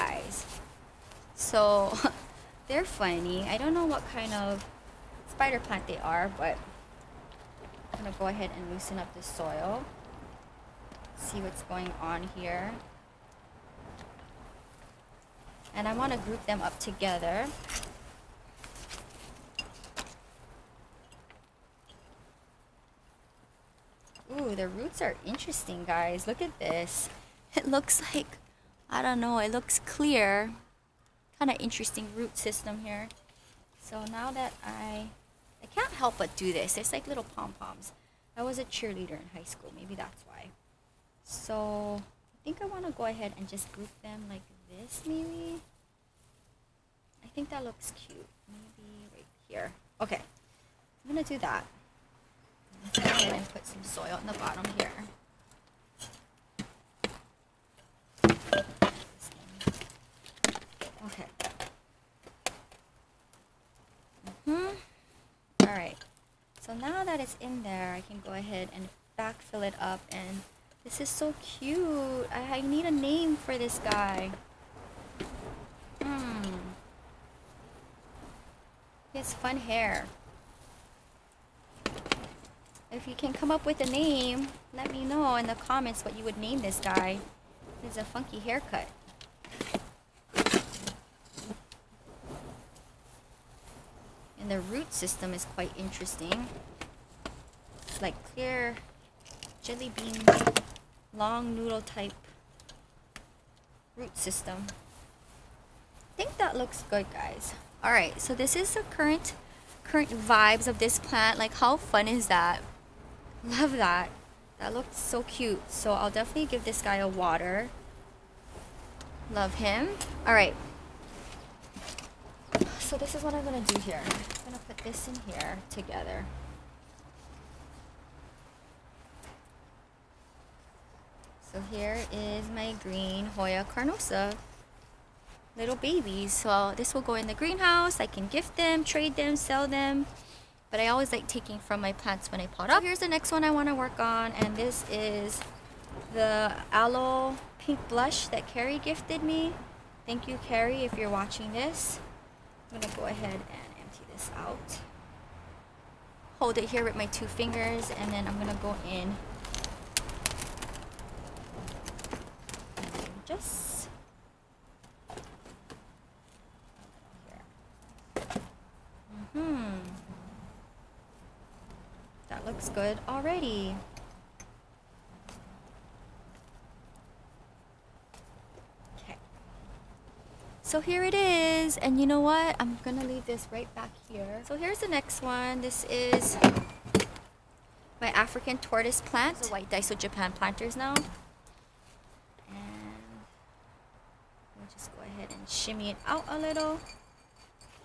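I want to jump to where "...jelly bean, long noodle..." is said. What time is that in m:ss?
1:39.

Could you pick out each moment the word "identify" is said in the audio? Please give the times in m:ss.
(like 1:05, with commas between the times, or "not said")
not said.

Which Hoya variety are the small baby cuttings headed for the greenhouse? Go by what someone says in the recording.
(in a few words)
Green Hoya carnosa.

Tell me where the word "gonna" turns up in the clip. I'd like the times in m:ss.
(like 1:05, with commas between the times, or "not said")
0:08, 2:03, 2:38, 3:02.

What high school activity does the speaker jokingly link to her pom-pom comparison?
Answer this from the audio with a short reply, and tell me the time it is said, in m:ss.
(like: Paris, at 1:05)
Cheerleader, at 0:38.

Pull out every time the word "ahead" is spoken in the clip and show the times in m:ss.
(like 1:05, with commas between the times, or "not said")
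0:08, 0:43, 0:53, 1:08, 2:33, 3:15.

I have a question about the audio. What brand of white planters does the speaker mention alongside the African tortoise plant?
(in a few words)
Daiso Japan.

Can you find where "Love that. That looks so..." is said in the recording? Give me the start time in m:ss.
1:53.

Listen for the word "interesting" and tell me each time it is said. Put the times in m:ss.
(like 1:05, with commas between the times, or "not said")
0:25, 0:31, 1:35.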